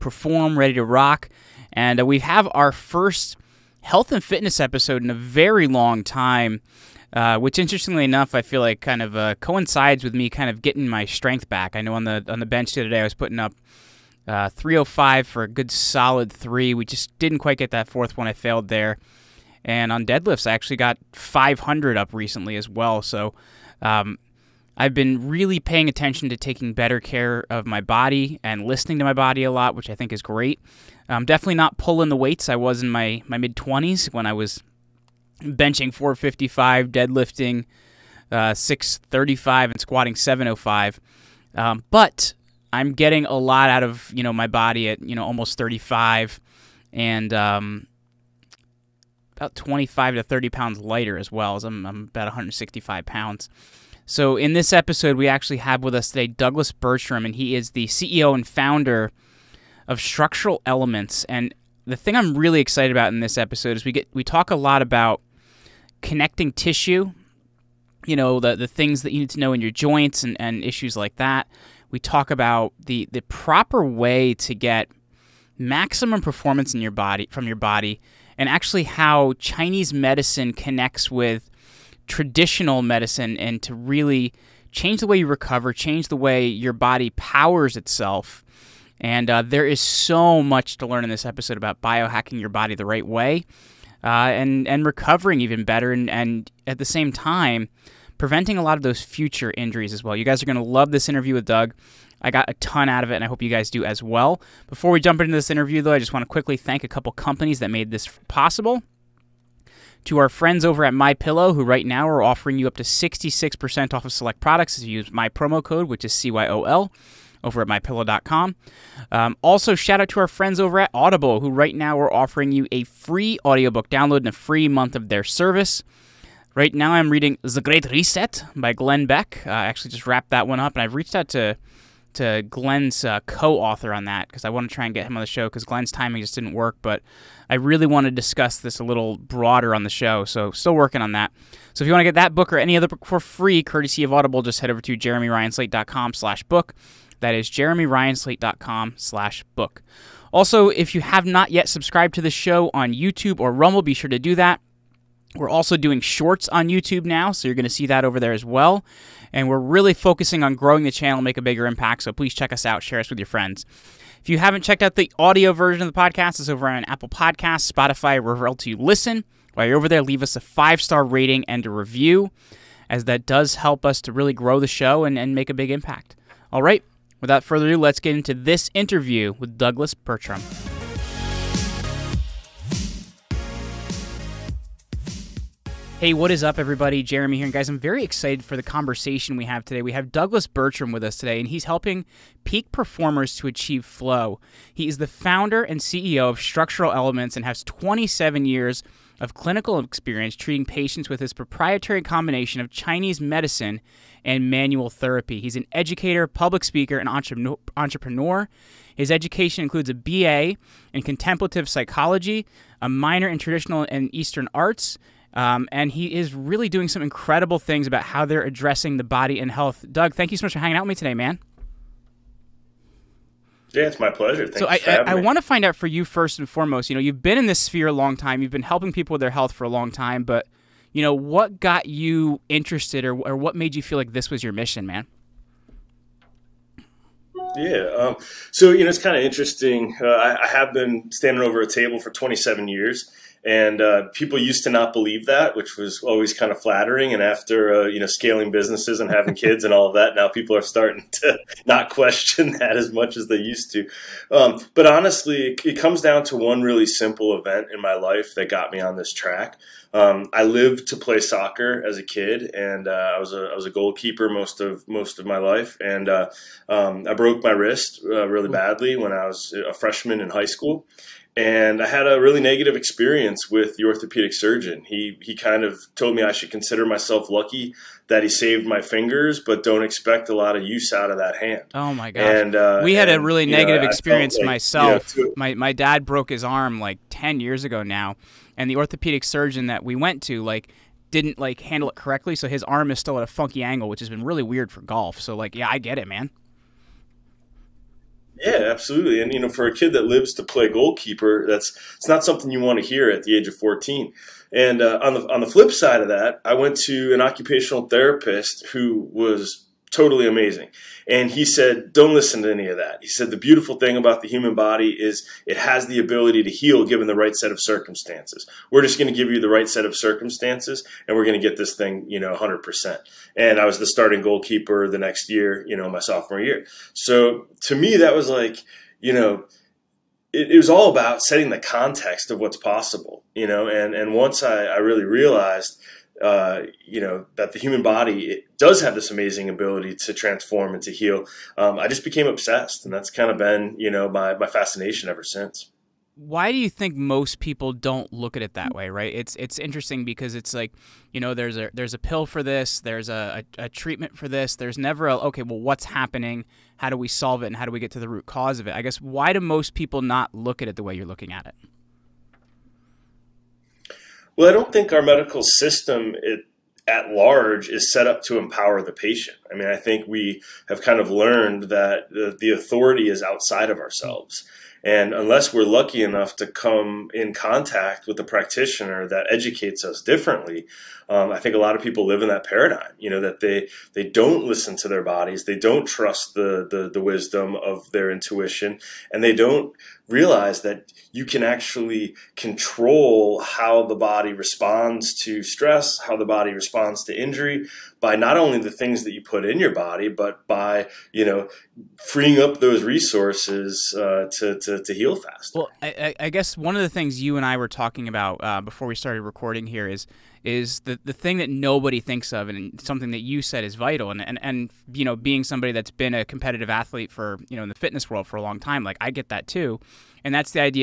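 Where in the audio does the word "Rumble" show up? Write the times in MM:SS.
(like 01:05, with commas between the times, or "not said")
02:33.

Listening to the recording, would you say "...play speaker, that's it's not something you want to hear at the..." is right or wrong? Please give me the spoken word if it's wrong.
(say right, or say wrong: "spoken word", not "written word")
wrong: "goalkeeper", not "speaker".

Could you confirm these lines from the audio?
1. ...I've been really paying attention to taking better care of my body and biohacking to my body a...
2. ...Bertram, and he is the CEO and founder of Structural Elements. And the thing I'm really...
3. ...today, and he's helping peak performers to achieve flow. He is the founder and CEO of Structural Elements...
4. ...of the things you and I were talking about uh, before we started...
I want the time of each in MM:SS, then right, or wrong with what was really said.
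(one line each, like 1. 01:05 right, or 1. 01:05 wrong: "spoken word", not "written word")
1. 00:24 wrong: "listening", not "biohacking"
2. 00:56 right
3. 03:11 right
4. 06:46 right.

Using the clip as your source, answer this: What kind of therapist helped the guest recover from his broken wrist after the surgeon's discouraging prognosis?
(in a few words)
Occupational therapist.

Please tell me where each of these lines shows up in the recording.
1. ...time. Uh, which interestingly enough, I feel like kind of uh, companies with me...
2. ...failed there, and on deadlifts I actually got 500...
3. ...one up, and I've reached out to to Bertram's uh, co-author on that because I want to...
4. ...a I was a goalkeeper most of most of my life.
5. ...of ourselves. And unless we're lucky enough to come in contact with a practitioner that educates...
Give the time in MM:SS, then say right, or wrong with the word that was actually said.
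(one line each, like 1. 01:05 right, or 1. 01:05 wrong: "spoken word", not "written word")
1. 00:06 wrong: "coincides", not "companies"
2. 00:18 right
3. 02:10 wrong: "Glenn", not "Bertram"
4. 04:23 right
5. 06:13 right.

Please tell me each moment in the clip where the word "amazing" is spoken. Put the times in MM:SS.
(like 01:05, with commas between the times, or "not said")
05:10, 05:39.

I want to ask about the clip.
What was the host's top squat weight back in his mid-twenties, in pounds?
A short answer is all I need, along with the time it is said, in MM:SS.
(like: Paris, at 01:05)
705, at 00:40.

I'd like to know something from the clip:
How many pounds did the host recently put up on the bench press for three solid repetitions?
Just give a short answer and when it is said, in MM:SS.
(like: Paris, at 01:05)
305, at 00:14.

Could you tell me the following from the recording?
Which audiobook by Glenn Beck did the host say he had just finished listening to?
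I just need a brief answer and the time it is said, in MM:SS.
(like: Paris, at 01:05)
The Great Reset, at 02:07.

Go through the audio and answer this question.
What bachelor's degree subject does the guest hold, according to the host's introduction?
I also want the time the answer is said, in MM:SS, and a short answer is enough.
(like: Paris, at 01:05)
Contemplative psychology, at 03:31.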